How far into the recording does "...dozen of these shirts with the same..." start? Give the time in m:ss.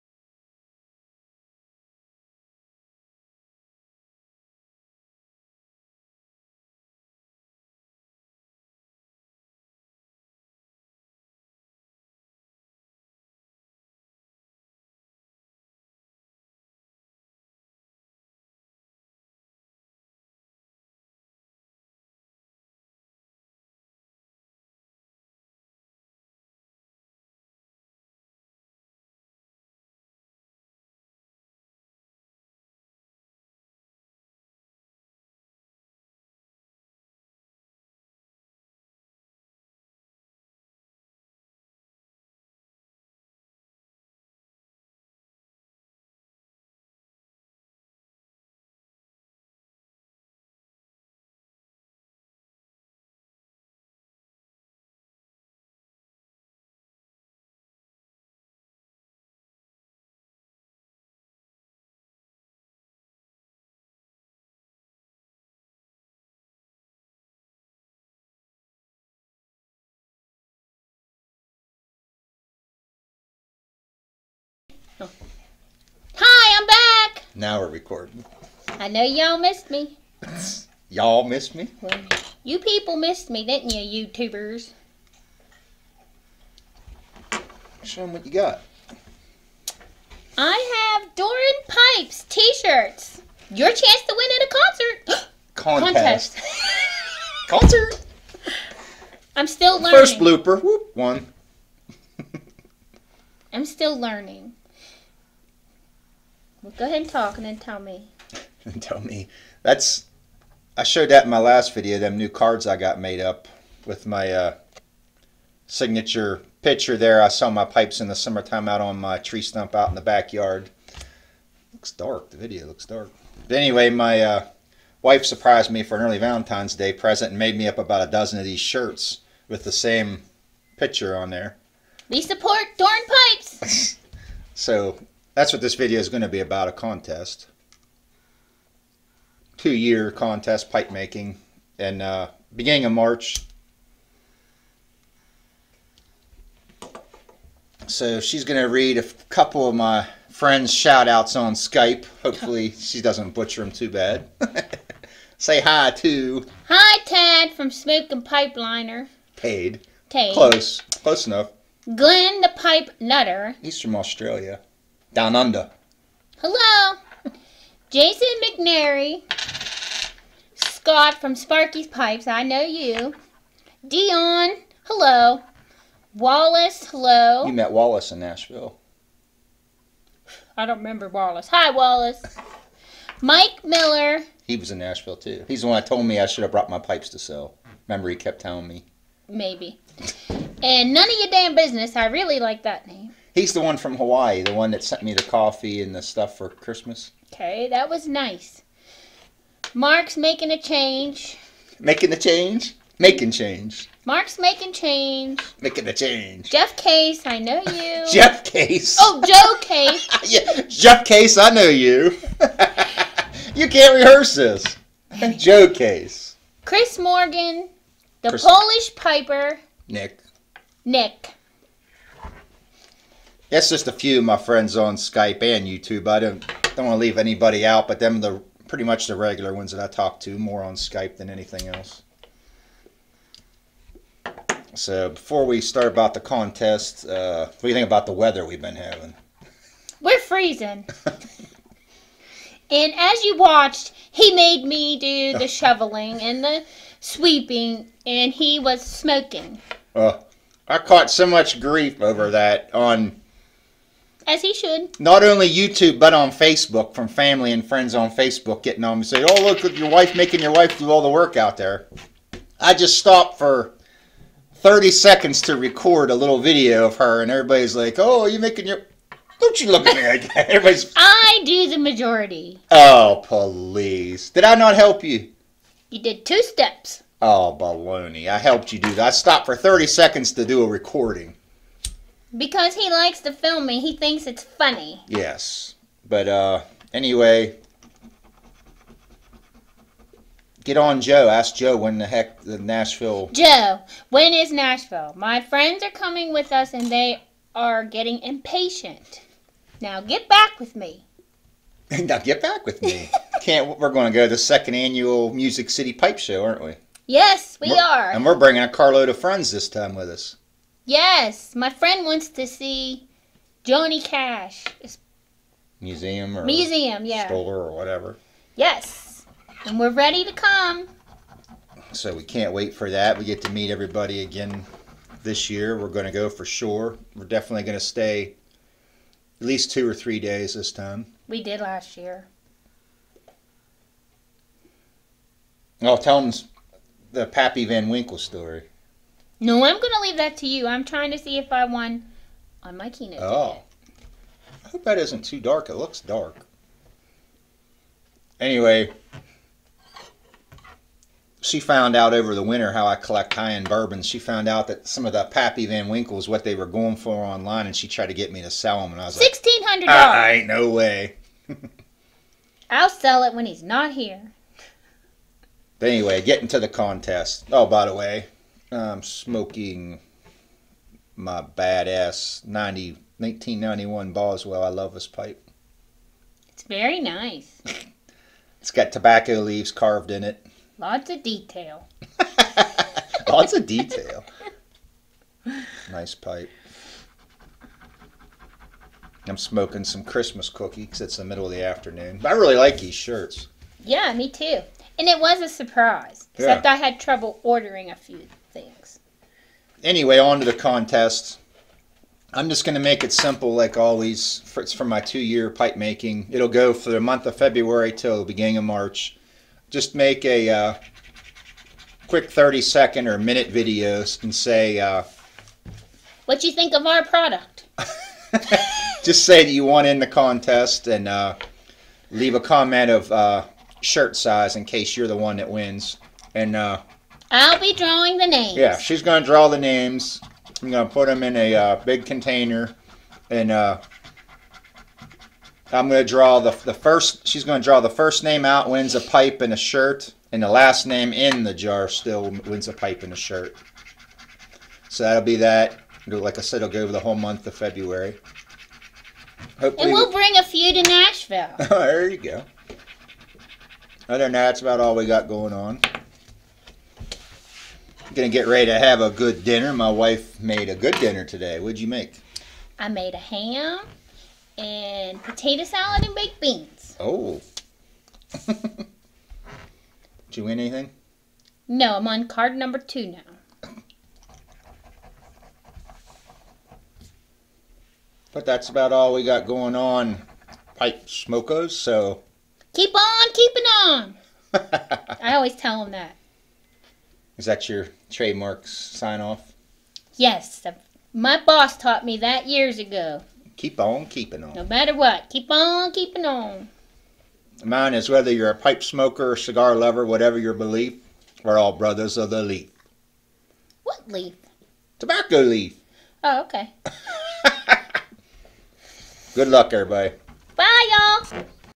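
2:08.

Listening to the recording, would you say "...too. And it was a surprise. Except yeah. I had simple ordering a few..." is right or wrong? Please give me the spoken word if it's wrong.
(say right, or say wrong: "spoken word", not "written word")
wrong: "trouble", not "simple".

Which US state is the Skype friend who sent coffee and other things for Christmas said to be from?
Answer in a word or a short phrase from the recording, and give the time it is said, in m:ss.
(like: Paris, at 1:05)
Hawaii, at 3:13.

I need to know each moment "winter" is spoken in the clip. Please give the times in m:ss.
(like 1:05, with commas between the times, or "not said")
5:52.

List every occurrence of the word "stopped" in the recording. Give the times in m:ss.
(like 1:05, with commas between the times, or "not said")
4:22, 4:39.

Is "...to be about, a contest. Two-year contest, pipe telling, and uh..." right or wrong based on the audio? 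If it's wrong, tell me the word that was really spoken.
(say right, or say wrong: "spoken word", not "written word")
wrong: "making", not "telling".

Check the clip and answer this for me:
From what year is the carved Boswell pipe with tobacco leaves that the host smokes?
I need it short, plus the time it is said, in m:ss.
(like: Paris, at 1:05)
1991, at 6:13.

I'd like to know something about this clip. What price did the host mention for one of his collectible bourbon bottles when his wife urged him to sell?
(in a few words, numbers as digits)
$1,600.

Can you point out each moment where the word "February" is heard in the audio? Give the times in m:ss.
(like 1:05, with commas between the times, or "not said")
6:47, 7:27.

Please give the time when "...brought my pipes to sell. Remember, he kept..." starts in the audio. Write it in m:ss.
3:06.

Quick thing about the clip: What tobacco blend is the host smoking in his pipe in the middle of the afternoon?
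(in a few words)
Christmas cookies.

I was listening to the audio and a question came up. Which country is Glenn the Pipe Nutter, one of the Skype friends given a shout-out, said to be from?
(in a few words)
Australia.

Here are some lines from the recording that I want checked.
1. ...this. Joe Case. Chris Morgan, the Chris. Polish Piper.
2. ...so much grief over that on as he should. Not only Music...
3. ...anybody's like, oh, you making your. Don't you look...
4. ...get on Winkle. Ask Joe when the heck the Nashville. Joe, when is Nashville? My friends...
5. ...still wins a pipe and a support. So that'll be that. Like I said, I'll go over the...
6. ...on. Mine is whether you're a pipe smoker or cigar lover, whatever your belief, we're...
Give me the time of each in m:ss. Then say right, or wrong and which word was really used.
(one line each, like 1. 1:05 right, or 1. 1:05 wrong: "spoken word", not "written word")
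1. 3:34 right
2. 4:11 wrong: "YouTube", not "Music"
3. 4:27 wrong: "everybody", not "anybody"
4. 4:50 wrong: "Joe", not "Winkle"
5. 7:21 wrong: "shirt", not "support"
6. 8:16 right.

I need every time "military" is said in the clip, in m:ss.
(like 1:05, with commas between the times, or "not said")
not said.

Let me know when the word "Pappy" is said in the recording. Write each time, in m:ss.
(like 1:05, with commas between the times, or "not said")
5:37, 5:55.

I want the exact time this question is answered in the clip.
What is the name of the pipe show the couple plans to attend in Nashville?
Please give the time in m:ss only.
5:05.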